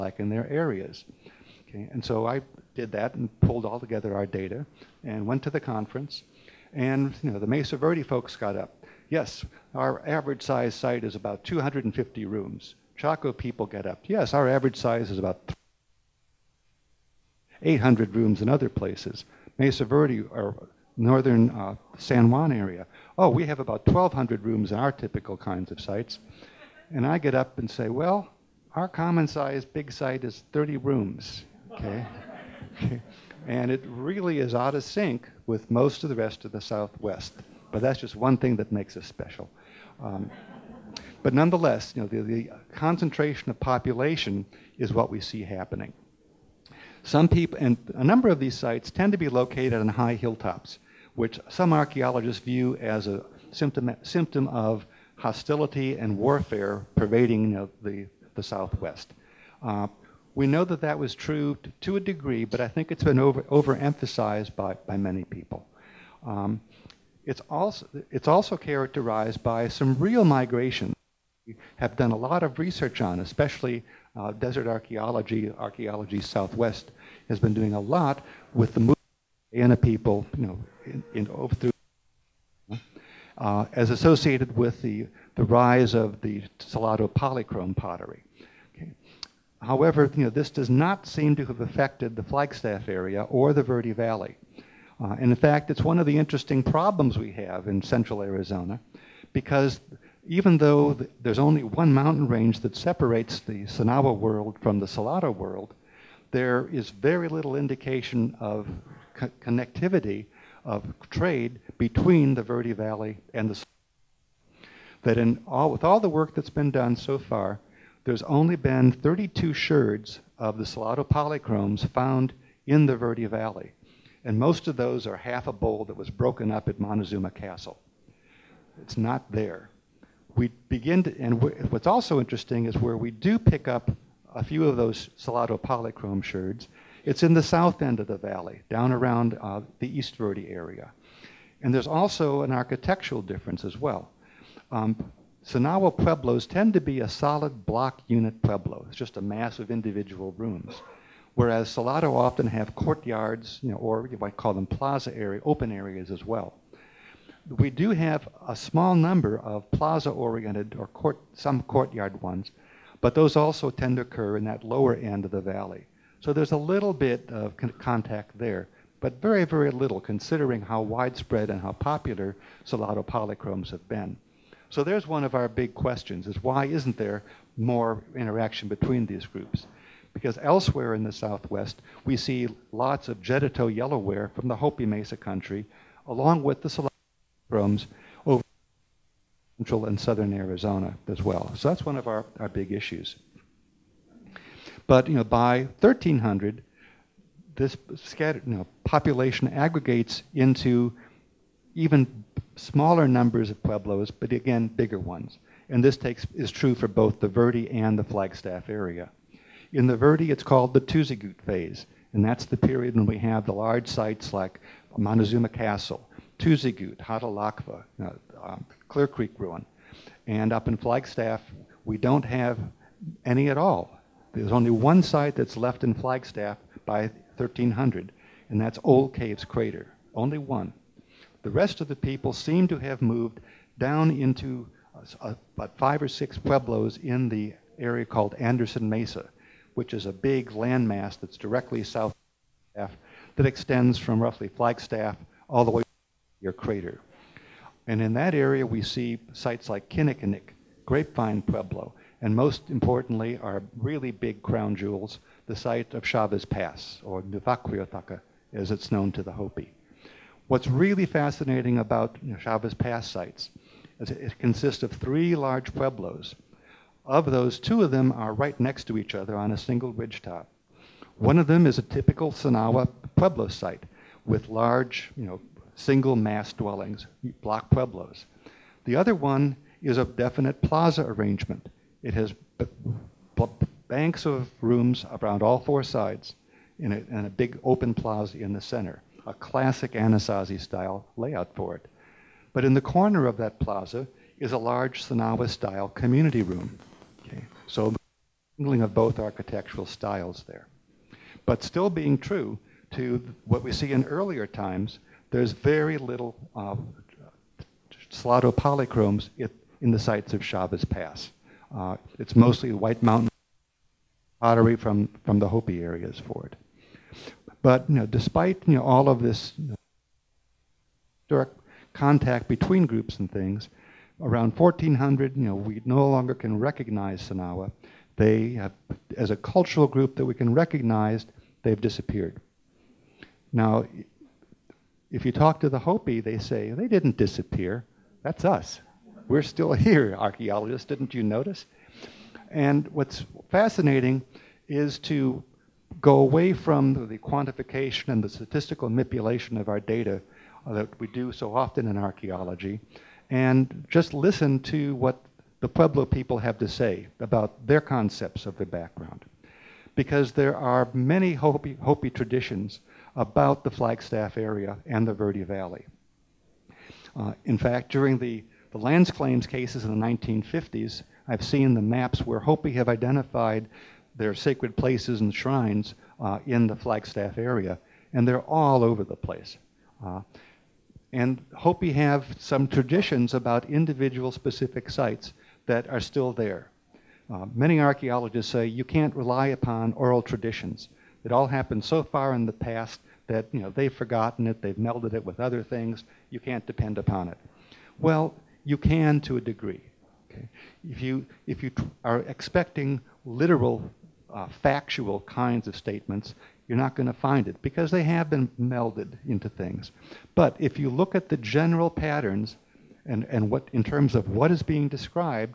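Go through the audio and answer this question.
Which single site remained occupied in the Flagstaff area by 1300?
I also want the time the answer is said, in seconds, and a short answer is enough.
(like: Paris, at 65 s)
Old Caves Crater, at 228 s.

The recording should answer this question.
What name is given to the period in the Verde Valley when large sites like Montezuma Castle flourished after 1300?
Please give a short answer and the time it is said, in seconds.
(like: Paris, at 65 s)
Tuzigoot phase, at 210 s.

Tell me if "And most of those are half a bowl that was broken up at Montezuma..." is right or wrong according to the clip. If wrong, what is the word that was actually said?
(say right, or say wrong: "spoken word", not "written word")
right.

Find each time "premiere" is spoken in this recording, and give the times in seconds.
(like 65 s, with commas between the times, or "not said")
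not said.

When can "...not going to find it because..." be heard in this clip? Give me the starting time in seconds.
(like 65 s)
406 s.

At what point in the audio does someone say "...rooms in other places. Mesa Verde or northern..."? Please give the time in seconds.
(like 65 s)
18 s.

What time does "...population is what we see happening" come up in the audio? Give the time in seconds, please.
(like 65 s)
43 s.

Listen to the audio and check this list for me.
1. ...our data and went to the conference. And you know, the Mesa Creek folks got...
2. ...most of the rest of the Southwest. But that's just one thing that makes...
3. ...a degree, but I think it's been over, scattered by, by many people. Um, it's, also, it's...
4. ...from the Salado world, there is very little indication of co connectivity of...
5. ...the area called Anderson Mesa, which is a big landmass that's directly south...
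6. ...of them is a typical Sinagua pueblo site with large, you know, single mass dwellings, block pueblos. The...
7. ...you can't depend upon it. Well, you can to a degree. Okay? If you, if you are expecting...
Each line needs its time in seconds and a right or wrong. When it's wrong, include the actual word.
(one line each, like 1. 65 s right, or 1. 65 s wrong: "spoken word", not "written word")
1. 4 s wrong: "Verde", not "Creek"
2. 35 s right
3. 61 s wrong: "overemphasized", not "scattered"
4. 104 s right
5. 237 s right
6. 271 s right
7. 396 s right.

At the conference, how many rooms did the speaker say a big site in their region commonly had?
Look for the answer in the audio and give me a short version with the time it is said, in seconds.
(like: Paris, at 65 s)
30 rooms, at 30 s.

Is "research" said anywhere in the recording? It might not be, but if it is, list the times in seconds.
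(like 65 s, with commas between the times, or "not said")
72 s.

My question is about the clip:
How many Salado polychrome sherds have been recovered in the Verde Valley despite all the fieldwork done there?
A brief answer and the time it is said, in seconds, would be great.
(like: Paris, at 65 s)
32, at 118 s.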